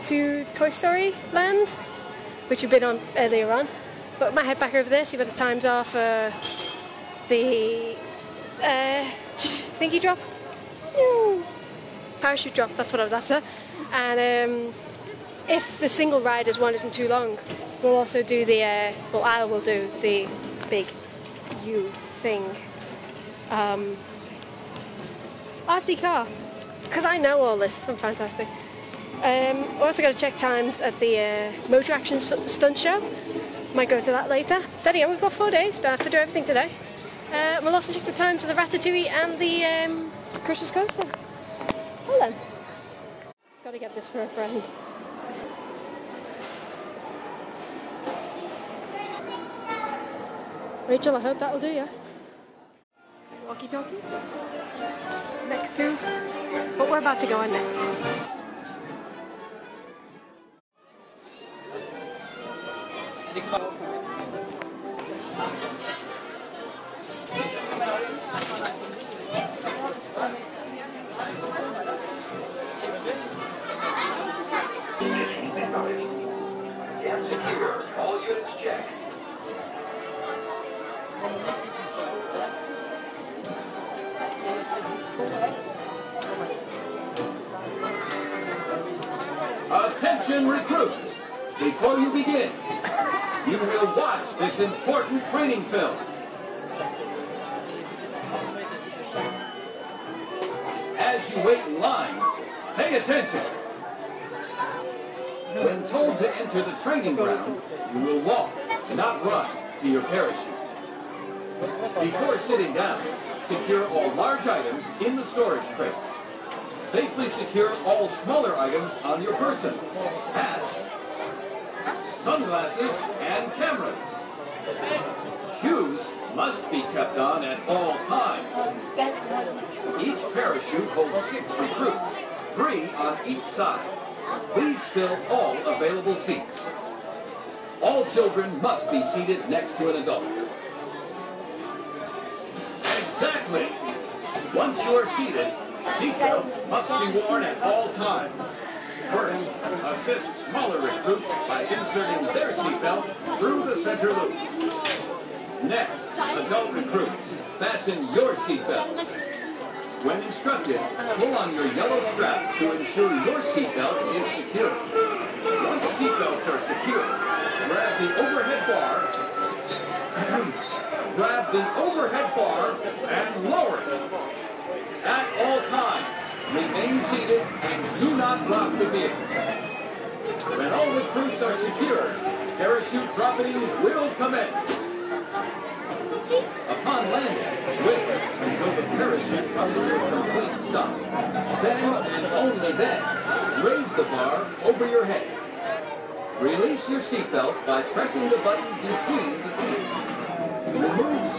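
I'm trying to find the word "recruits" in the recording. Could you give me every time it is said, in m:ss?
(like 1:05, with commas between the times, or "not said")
1:30, 2:11, 2:30, 2:36, 3:00.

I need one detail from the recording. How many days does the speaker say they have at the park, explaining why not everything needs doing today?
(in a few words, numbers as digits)
4.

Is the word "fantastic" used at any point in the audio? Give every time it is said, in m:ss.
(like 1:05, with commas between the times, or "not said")
0:27.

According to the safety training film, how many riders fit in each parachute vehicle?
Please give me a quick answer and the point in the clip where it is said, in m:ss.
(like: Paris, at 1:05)
6, at 2:11.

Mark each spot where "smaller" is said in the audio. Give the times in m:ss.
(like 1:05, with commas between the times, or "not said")
1:58, 2:30.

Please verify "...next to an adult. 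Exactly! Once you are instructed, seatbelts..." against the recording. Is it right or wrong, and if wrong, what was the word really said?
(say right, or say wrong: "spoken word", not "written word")
wrong: "seated", not "instructed".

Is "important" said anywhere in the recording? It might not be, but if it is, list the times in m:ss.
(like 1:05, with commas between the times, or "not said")
1:34.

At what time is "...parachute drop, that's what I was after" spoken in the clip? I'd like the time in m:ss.
0:12.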